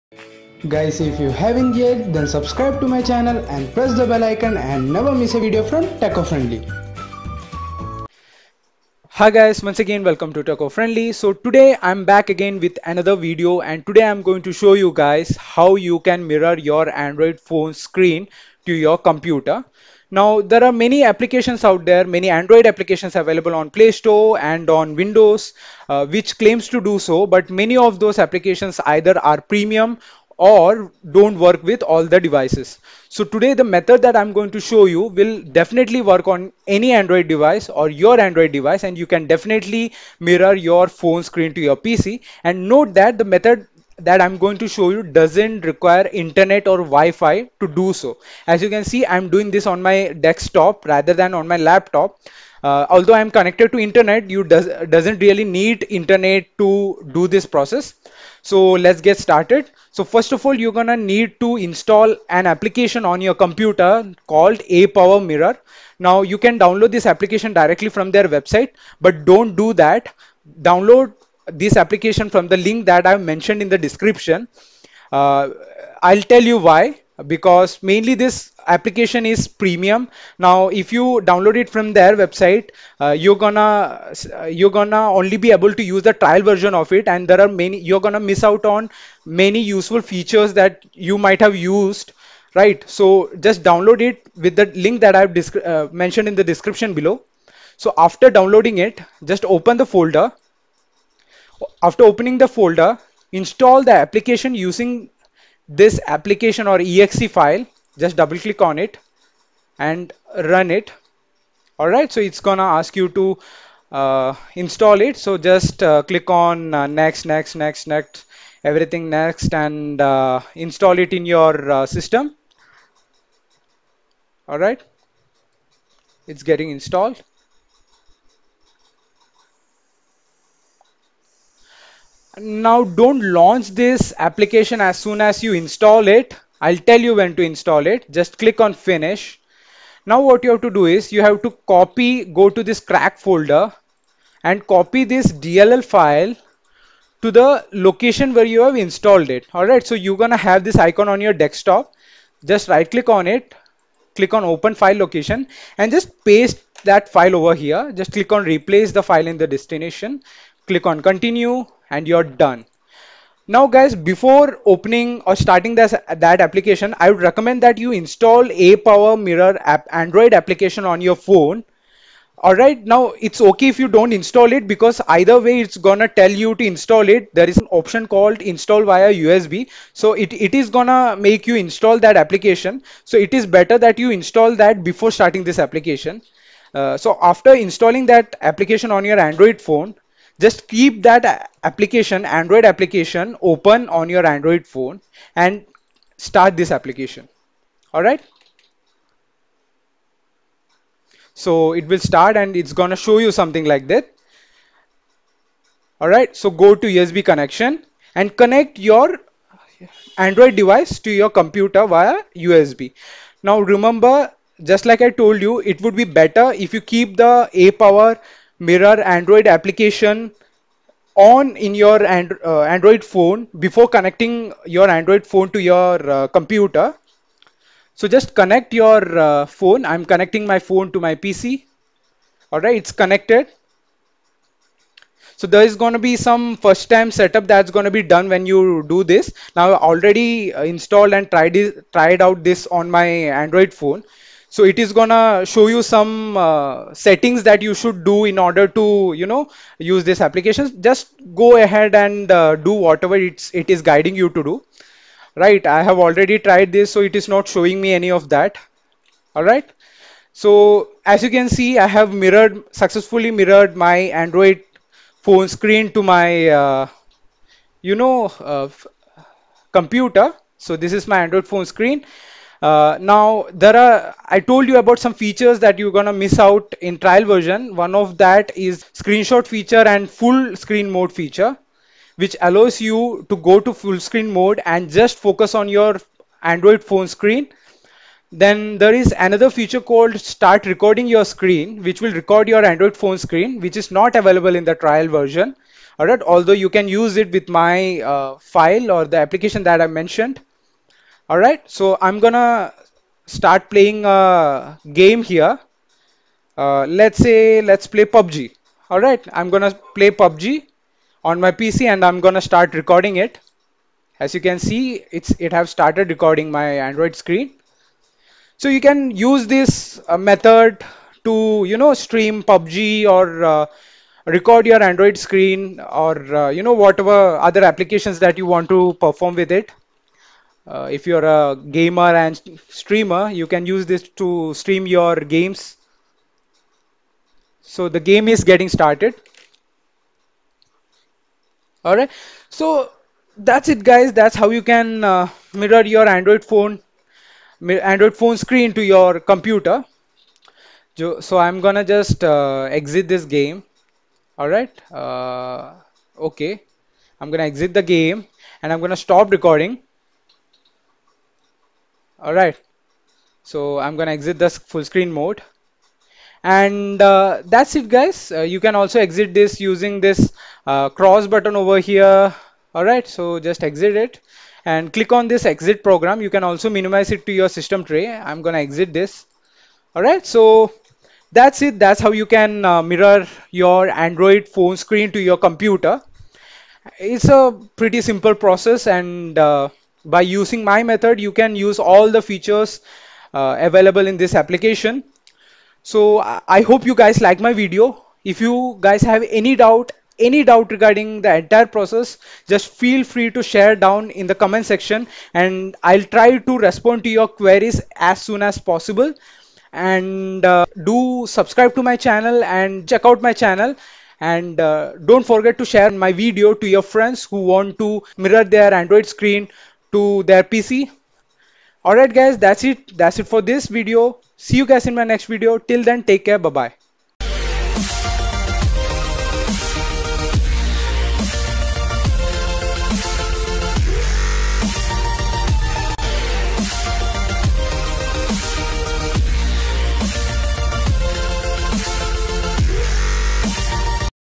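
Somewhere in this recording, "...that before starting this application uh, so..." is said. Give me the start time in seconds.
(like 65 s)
184 s.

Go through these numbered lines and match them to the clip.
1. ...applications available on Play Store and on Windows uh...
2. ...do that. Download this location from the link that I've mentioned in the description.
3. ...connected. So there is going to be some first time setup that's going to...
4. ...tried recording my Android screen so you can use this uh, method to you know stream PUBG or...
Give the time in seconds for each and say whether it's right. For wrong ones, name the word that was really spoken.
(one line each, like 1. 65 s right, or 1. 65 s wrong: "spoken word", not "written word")
1. 22 s right
2. 69 s wrong: "application", not "location"
3. 232 s right
4. 315 s wrong: "started", not "tried".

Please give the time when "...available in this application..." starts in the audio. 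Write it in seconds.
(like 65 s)
393 s.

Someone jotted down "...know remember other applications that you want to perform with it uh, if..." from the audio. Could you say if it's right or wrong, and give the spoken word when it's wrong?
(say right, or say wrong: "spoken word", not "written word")
wrong: "whatever", not "remember".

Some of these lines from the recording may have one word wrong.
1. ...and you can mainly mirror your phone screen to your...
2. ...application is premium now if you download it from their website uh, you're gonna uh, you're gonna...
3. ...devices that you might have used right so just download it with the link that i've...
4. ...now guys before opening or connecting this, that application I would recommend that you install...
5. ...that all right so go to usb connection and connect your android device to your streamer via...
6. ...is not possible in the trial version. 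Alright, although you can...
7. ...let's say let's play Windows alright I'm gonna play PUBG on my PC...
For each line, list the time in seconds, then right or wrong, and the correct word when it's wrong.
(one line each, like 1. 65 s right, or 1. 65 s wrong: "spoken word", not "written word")
1. 38 s wrong: "definitely", not "mainly"
2. 78 s right
3. 90 s wrong: "features", not "devices"
4. 163 s wrong: "starting", not "connecting"
5. 203 s wrong: "computer", not "streamer"
6. 293 s wrong: "available", not "possible"
7. 306 s wrong: "PUBG", not "Windows".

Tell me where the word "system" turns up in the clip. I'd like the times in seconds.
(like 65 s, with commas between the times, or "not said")
121 s, 377 s.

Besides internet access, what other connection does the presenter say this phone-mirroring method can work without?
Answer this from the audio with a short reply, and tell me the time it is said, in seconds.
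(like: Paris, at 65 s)
Wi-Fi, at 46 s.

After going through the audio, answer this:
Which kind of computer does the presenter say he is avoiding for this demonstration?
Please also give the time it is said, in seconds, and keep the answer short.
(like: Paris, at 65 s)
laptop, at 51 s.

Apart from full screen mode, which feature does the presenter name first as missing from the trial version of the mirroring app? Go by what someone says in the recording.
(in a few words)
screenshot feature.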